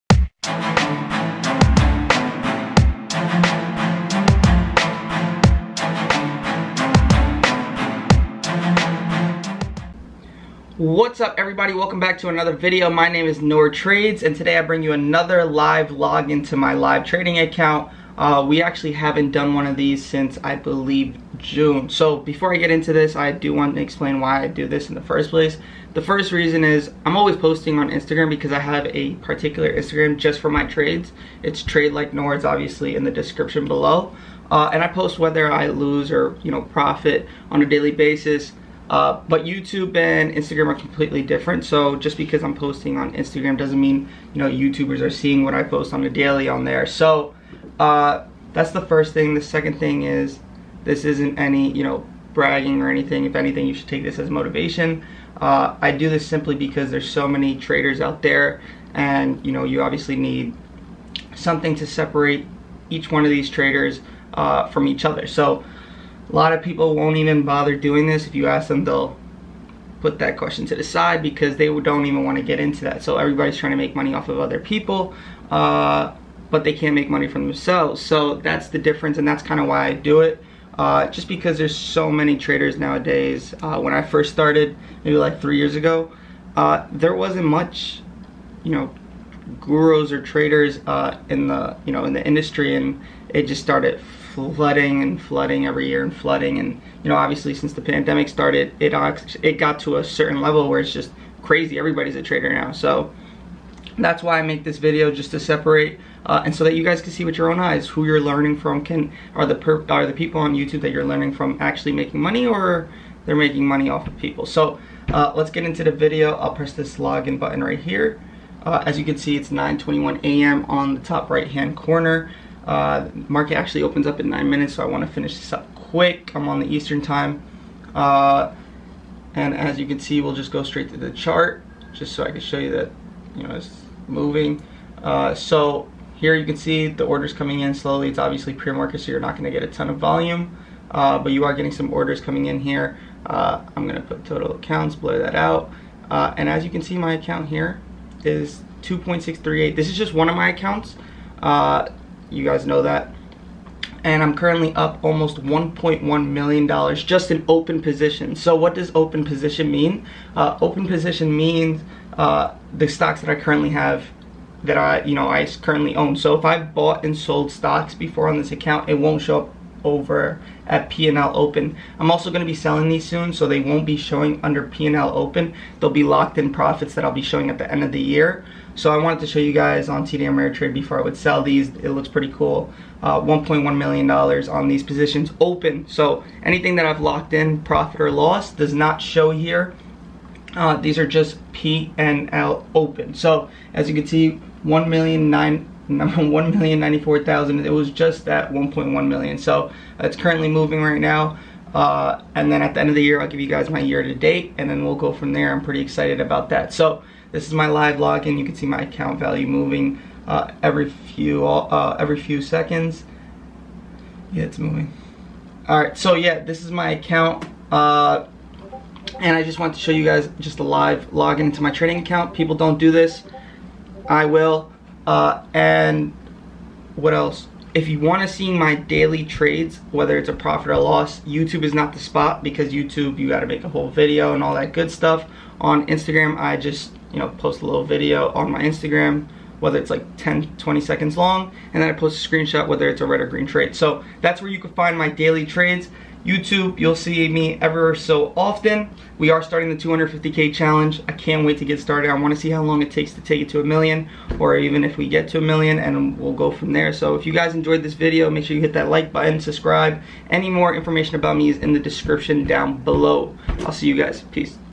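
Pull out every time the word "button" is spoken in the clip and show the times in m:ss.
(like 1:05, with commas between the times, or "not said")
1:57, 4:19.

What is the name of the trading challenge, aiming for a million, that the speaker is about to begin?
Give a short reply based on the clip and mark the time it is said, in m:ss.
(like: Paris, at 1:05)
250K challenge, at 4:09.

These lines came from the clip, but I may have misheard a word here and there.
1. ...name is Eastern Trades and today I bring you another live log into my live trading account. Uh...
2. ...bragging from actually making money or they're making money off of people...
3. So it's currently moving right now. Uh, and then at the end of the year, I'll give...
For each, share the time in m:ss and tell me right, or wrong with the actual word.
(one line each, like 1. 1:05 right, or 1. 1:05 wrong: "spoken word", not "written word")
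1. 0:13 wrong: "Nour", not "Eastern"
2. 1:51 wrong: "learning", not "bragging"
3. 3:19 right.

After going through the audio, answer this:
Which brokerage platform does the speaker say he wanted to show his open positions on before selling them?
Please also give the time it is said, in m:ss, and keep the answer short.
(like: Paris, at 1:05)
TD Ameritrade, at 3:00.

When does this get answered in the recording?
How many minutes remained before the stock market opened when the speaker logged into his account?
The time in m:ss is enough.
2:04.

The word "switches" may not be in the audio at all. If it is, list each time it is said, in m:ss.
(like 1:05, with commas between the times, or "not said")
not said.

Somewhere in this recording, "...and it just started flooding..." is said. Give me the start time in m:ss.
1:32.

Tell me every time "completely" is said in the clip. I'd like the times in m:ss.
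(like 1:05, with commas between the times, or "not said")
0:40.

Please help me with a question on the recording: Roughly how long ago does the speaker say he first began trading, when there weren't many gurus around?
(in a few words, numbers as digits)
3 years ago.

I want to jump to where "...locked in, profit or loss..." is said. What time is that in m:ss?
3:07.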